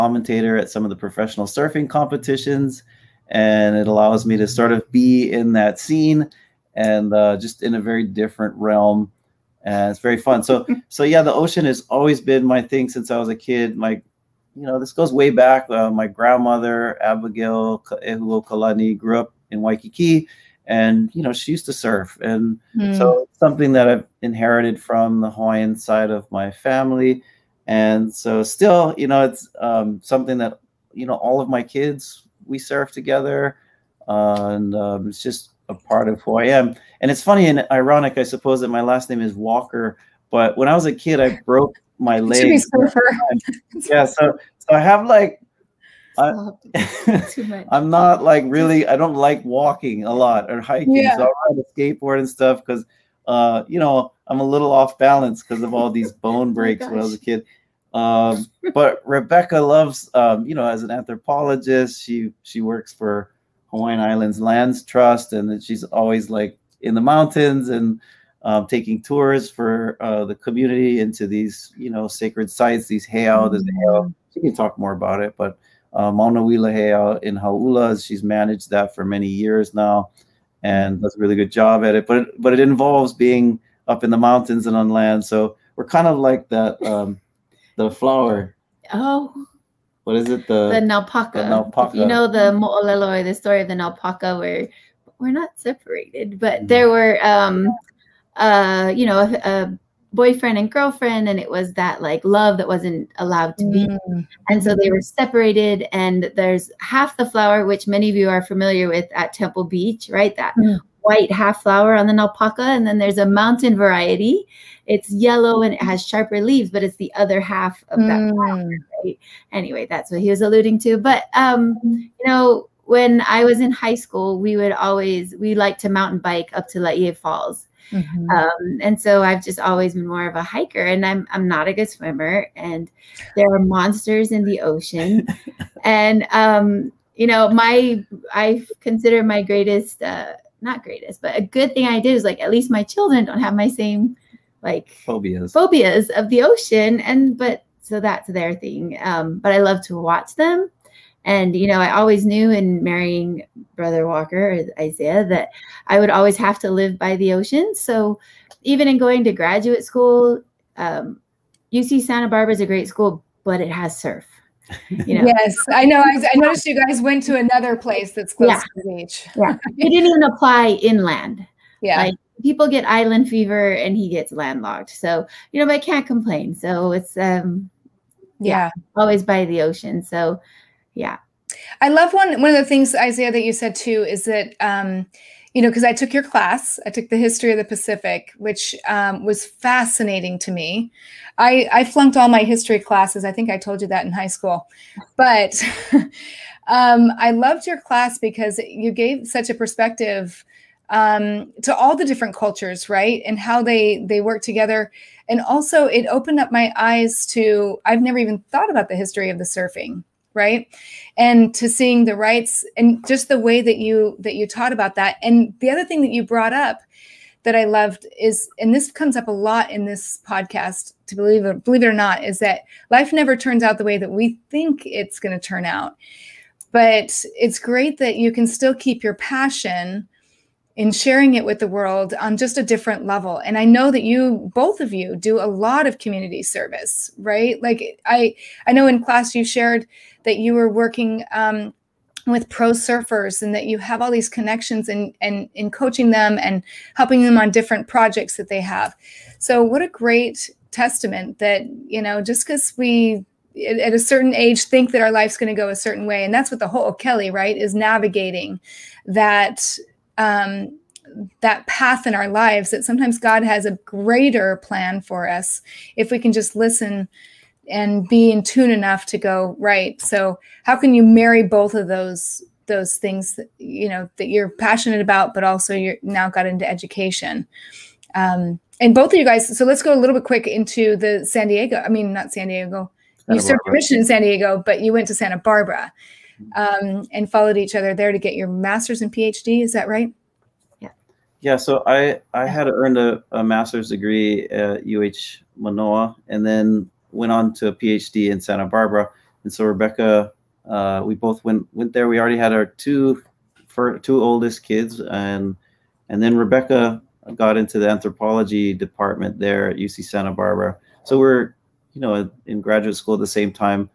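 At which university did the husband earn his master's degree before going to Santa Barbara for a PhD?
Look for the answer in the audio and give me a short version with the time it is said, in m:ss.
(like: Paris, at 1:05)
UH Manoa, at 4:54.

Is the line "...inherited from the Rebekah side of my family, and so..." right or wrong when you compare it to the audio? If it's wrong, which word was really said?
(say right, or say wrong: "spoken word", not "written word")
wrong: "Hawaiian", not "Rebekah".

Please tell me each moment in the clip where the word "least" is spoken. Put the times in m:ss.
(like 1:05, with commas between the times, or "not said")
2:22.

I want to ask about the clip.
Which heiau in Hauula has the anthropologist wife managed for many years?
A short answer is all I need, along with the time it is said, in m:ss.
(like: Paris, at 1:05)
Mauna Wila heiau, at 1:16.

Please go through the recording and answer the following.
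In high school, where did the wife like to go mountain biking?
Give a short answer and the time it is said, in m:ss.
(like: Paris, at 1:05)
Laie Falls, at 2:06.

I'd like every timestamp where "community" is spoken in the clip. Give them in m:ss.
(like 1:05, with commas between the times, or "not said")
1:10, 3:55.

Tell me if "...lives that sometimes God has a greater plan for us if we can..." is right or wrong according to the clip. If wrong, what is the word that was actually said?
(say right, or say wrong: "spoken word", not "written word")
right.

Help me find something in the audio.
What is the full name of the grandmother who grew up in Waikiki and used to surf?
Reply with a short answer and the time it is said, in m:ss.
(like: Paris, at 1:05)
Abigail Ehulo Kalani, at 0:17.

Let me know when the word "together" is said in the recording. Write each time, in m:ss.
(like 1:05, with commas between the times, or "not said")
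0:32, 3:24.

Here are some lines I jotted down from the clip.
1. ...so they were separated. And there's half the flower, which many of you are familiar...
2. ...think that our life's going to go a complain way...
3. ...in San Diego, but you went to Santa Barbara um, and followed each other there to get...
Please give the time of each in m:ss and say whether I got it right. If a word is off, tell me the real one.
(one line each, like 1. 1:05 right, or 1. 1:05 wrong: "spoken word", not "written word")
1. 1:44 right
2. 4:14 wrong: "certain", not "complain"
3. 4:43 right.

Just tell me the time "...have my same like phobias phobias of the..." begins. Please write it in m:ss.
2:23.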